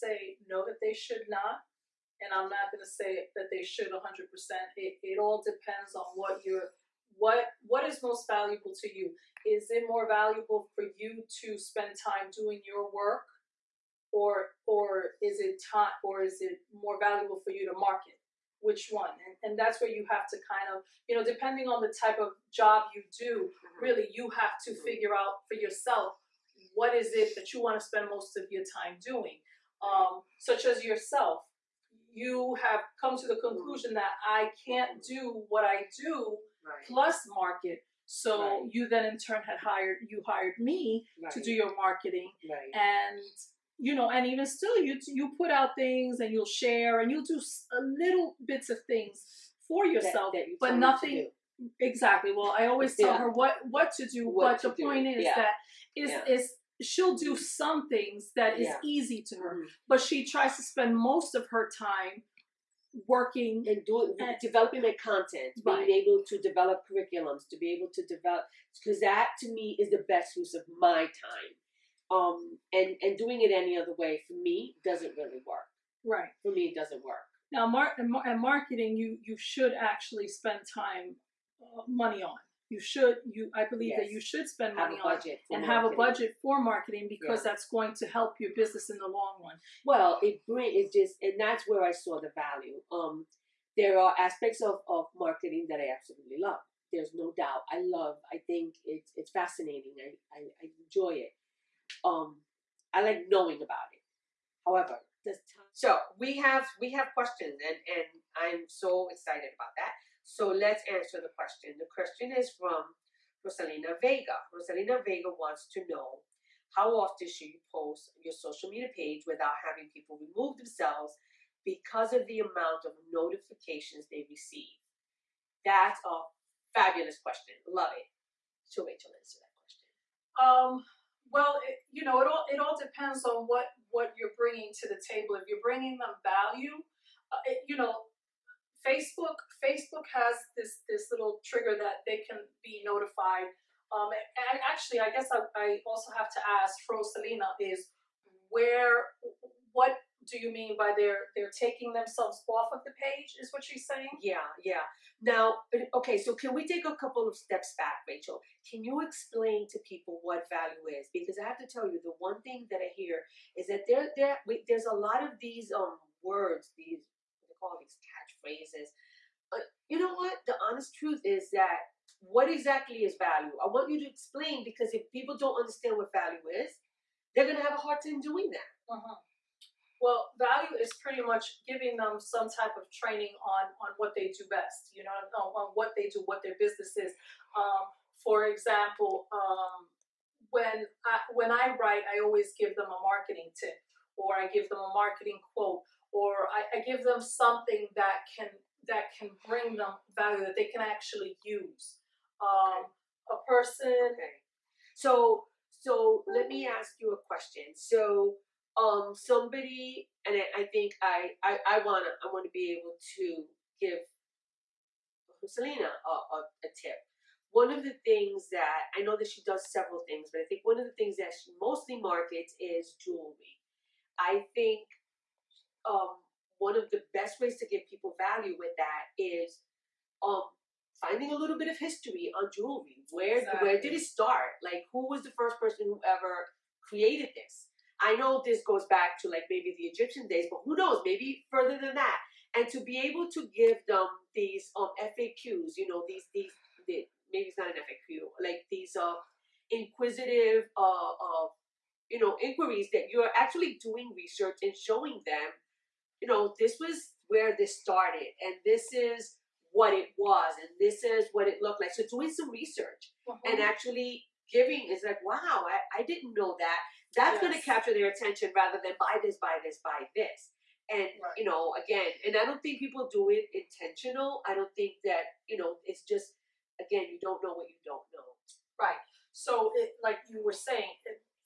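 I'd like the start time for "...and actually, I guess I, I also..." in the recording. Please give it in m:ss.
2:24.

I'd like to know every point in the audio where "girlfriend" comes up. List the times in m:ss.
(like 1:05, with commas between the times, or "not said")
not said.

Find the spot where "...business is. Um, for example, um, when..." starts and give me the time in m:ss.
3:06.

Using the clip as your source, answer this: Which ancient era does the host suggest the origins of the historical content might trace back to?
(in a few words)
Egyptian days.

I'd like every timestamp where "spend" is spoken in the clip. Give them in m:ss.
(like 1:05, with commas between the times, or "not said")
0:11, 0:27, 1:00, 1:20, 1:24.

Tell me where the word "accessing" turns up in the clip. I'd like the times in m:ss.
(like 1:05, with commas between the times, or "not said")
not said.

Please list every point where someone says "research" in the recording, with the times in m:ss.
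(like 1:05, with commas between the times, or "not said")
4:14, 4:22.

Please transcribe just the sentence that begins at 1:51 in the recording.
The question is from Rosalina Vega.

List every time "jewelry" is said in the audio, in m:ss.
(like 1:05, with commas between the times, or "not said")
3:43, 3:52.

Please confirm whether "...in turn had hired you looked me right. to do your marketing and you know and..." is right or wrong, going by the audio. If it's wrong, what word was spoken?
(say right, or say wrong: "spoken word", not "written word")
wrong: "hired", not "looked".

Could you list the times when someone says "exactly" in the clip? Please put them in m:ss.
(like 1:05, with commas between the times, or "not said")
0:51, 2:52, 3:53.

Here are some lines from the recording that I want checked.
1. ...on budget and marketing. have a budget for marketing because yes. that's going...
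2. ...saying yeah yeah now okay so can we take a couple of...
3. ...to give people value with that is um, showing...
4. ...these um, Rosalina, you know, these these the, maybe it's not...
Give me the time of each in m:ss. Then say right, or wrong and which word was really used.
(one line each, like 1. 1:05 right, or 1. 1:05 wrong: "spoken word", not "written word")
1. 1:24 right
2. 2:33 right
3. 3:47 wrong: "finding", not "showing"
4. 4:04 wrong: "FAQs", not "Rosalina".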